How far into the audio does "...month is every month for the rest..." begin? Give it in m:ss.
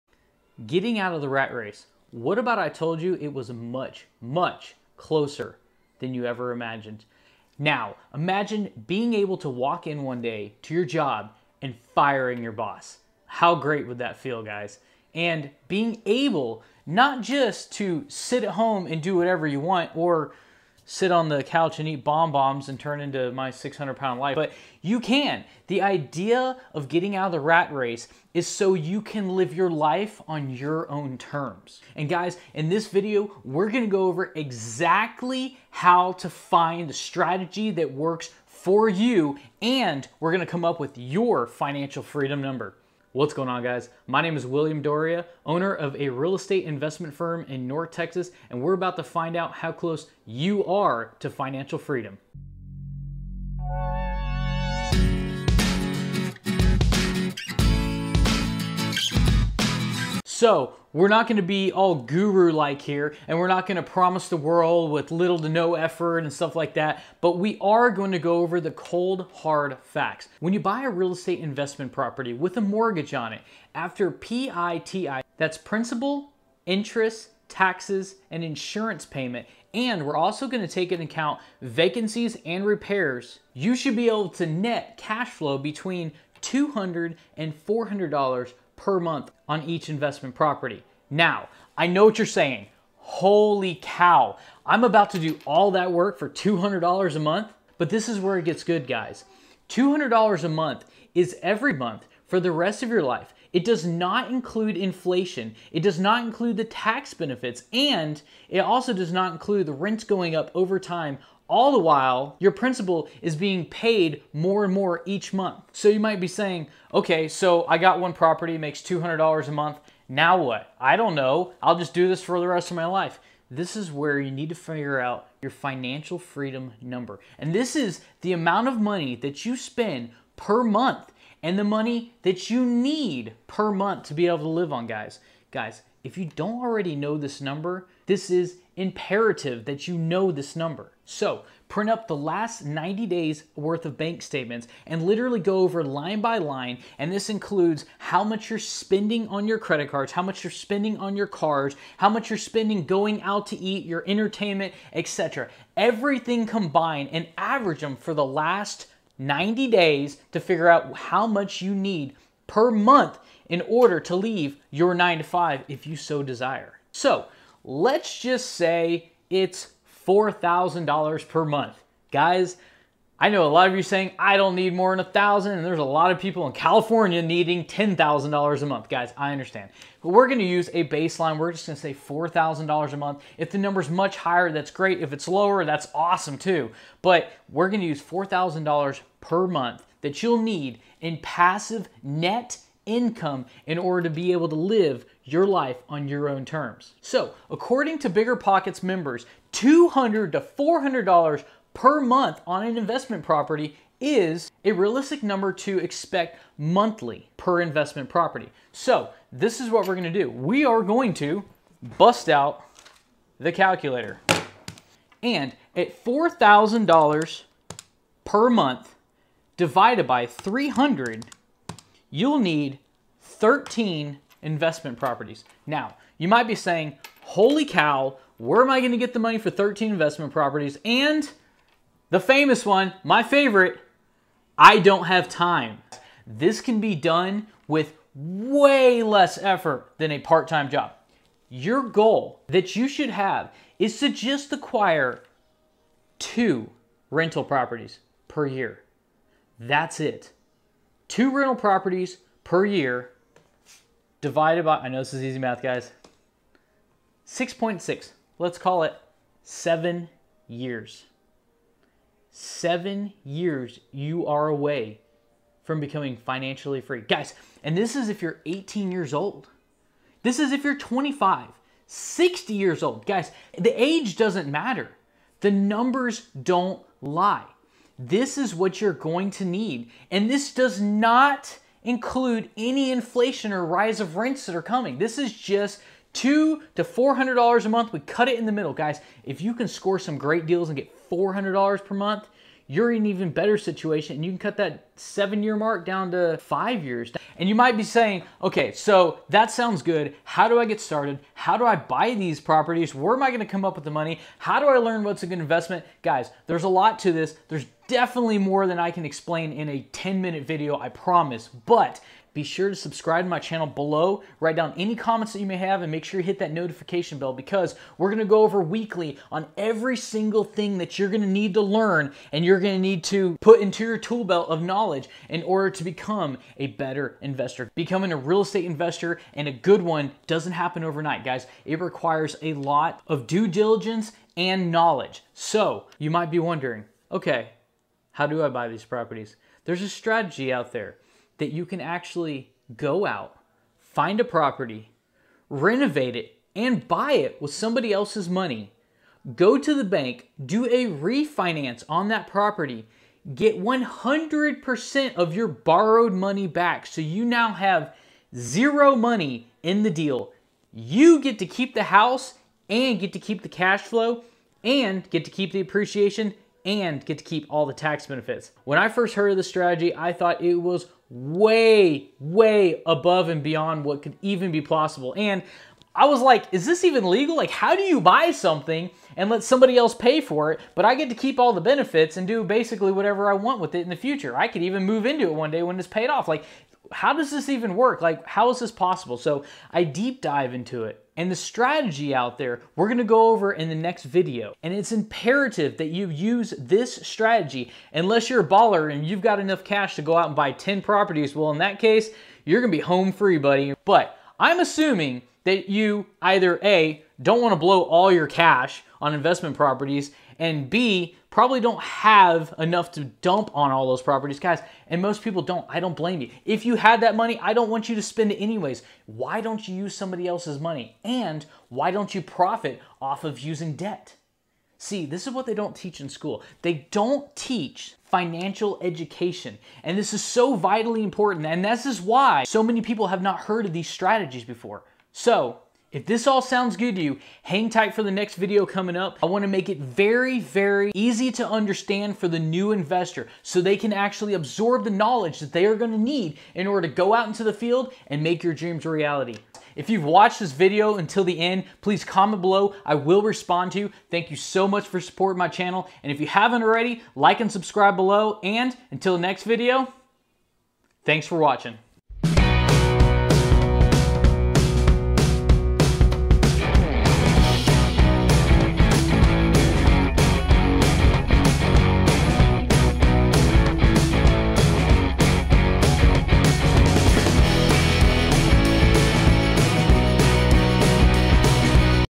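1:40.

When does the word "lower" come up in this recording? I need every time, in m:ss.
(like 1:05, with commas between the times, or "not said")
3:05.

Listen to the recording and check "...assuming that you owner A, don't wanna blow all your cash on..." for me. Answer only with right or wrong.
wrong.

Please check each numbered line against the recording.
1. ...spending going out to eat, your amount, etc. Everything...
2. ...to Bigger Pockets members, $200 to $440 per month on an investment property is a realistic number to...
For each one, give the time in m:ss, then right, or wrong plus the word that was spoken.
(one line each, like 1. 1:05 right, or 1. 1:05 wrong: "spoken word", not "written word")
1. 2:32 wrong: "entertainment", not "amount"
2. 3:17 wrong: "400", not "440".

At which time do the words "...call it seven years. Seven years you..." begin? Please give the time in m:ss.
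4:18.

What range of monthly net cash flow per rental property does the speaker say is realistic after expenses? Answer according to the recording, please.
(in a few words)
$200 to $400.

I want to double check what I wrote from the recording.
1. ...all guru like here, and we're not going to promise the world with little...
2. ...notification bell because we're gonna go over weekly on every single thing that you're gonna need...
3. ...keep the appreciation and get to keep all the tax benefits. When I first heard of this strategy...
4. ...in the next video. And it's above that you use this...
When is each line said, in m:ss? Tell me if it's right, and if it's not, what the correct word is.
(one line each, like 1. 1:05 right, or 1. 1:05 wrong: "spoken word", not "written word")
1. 1:01 right
2. 5:16 right
3. 6:05 right
4. 6:33 wrong: "imperative", not "above".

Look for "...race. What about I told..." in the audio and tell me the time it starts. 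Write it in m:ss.
0:01.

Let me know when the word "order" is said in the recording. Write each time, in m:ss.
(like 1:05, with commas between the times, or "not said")
2:43, 3:13, 5:25, 7:26.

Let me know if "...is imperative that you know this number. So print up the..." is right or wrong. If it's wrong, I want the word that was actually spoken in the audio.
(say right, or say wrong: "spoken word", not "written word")
right.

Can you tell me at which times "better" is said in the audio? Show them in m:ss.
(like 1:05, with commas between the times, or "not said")
4:53, 5:26.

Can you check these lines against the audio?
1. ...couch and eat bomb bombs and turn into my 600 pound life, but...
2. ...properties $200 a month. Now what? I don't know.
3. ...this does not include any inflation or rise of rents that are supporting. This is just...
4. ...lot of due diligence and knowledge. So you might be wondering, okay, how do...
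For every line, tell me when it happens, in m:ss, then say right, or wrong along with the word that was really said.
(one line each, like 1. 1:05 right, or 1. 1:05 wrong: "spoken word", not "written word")
1. 0:21 right
2. 1:58 wrong: "makes", not "properties"
3. 4:40 wrong: "coming", not "supporting"
4. 5:32 right.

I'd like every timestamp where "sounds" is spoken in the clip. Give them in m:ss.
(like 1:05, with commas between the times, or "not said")
4:59, 7:16.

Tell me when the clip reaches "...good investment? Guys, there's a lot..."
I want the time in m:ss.
5:05.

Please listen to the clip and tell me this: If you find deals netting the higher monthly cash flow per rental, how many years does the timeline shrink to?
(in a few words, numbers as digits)
5.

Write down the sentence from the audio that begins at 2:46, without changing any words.
So Let's just say it's $4,000 per month.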